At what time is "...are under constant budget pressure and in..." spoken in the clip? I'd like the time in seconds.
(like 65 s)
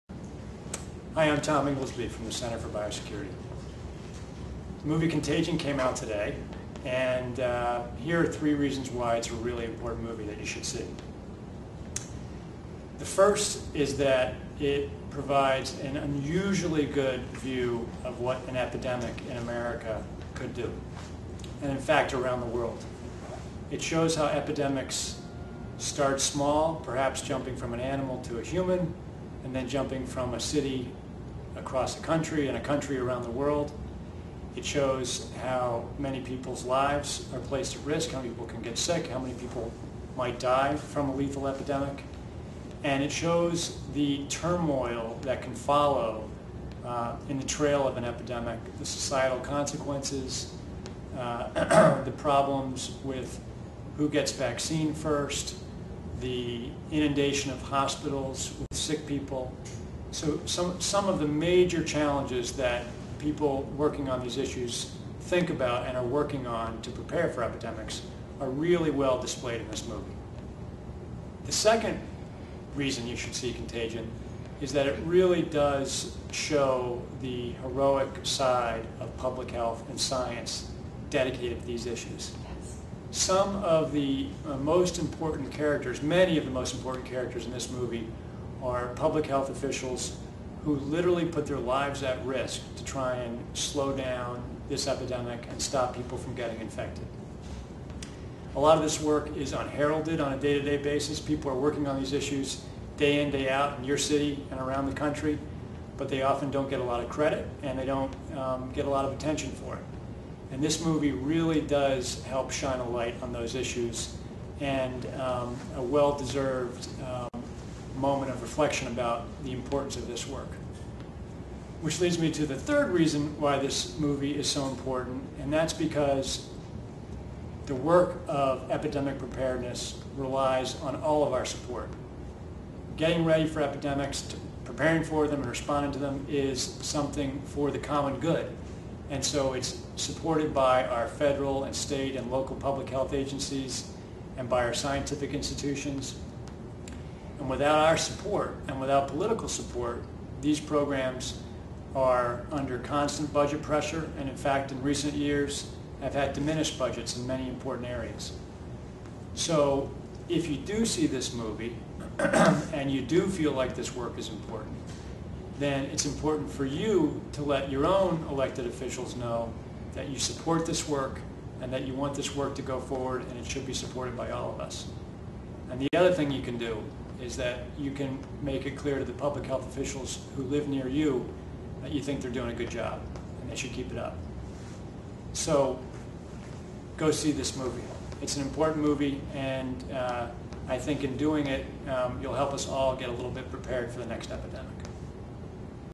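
151 s.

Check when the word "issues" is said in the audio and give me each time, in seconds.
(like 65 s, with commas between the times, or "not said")
64 s, 81 s, 102 s, 113 s.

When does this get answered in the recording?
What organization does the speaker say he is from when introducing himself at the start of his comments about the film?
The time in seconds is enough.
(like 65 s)
2 s.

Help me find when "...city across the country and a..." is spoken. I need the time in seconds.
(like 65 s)
30 s.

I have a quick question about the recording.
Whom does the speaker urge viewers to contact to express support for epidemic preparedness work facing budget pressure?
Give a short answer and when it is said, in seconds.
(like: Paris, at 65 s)
elected officials, at 168 s.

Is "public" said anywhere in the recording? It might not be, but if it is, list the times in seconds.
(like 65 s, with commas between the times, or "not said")
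79 s, 88 s, 142 s, 179 s.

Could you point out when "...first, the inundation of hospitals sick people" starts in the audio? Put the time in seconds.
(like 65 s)
54 s.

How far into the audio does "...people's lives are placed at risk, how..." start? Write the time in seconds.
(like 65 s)
36 s.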